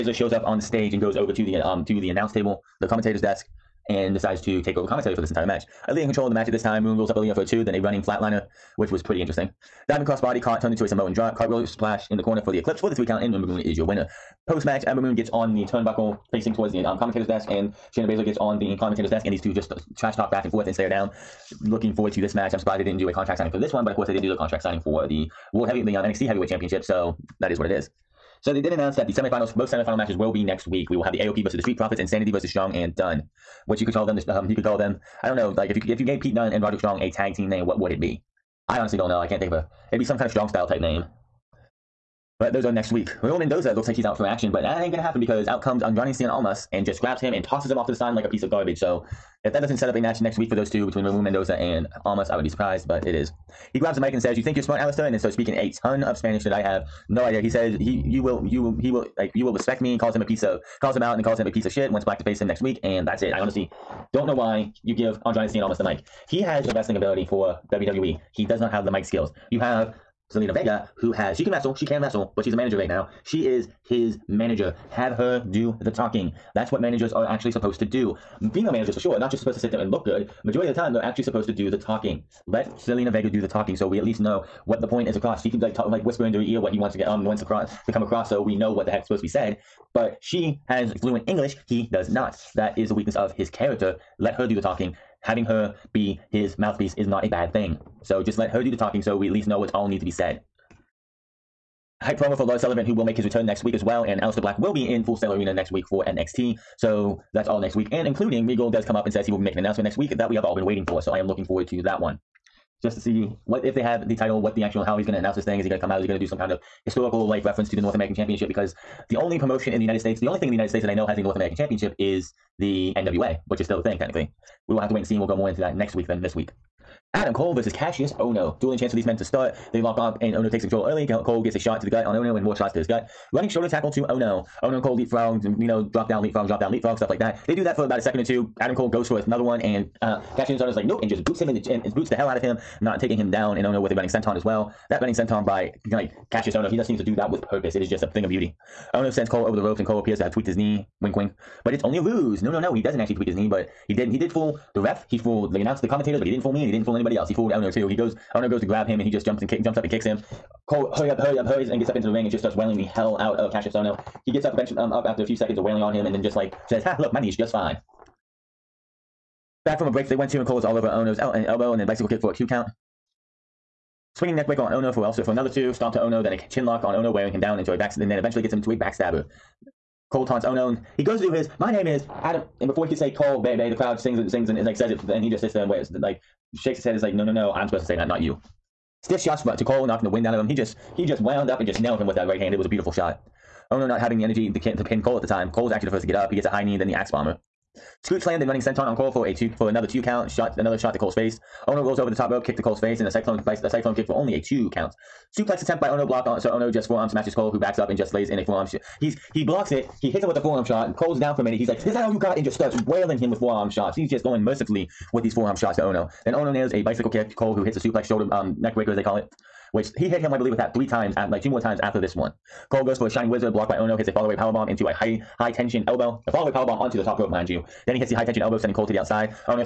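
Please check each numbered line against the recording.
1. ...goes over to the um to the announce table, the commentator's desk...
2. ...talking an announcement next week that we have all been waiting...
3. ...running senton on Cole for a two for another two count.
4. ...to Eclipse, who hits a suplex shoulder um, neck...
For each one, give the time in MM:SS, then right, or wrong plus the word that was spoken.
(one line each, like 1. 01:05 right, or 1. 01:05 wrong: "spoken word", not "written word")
1. 00:01 right
2. 01:49 wrong: "making", not "talking"
3. 03:18 right
4. 03:37 wrong: "Cole", not "Eclipse".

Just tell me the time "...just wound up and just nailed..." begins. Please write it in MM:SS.
03:11.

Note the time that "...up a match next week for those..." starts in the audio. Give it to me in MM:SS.
00:49.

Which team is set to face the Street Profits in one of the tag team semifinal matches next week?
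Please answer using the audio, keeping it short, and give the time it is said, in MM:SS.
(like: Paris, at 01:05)
AOP, at 00:31.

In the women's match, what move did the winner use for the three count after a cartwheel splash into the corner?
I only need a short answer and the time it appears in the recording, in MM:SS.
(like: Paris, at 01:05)
Eclipse, at 00:12.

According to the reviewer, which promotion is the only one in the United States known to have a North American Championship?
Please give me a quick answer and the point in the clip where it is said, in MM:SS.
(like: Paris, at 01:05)
NWA, at 02:02.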